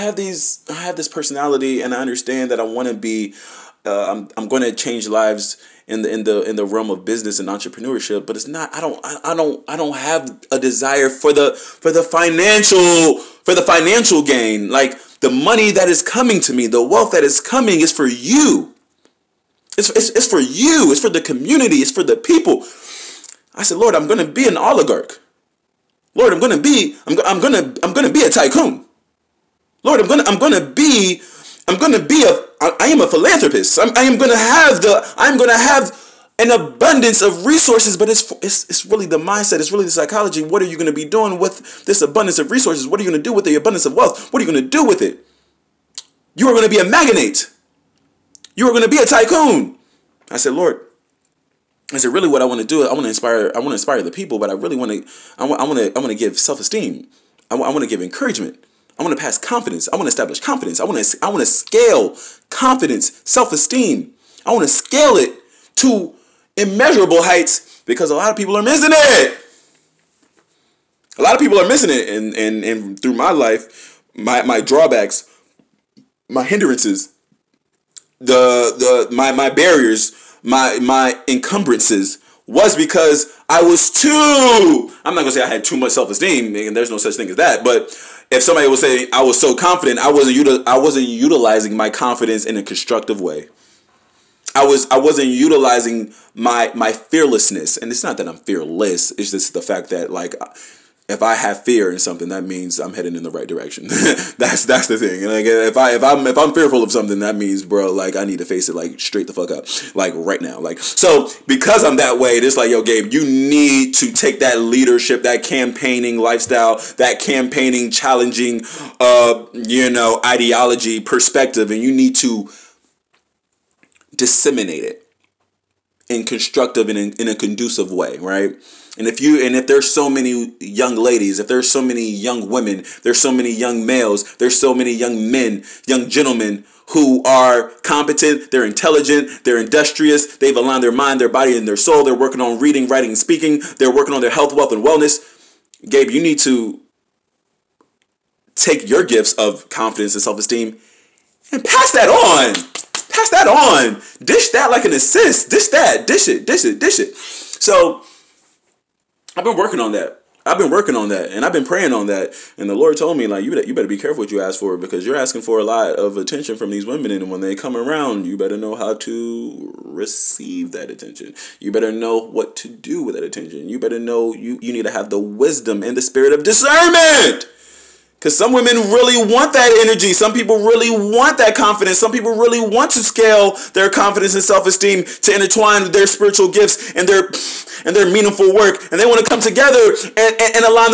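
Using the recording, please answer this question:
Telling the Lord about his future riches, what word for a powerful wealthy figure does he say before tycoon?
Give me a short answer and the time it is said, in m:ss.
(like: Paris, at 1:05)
oligarch, at 0:24.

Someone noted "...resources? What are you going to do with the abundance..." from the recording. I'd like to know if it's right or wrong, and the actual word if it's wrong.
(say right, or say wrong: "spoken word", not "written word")
right.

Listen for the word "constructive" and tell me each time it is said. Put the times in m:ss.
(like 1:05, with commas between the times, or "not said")
1:32, 2:06.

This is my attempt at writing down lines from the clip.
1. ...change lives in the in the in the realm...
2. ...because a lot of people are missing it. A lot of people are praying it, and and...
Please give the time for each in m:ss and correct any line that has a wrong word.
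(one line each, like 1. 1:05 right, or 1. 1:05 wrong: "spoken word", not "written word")
1. 0:04 right
2. 1:07 wrong: "missing", not "praying".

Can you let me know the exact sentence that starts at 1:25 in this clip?
I'm not gonna say I had too much self esteem, and there's no such thing as that.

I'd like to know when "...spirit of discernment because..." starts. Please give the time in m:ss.
2:56.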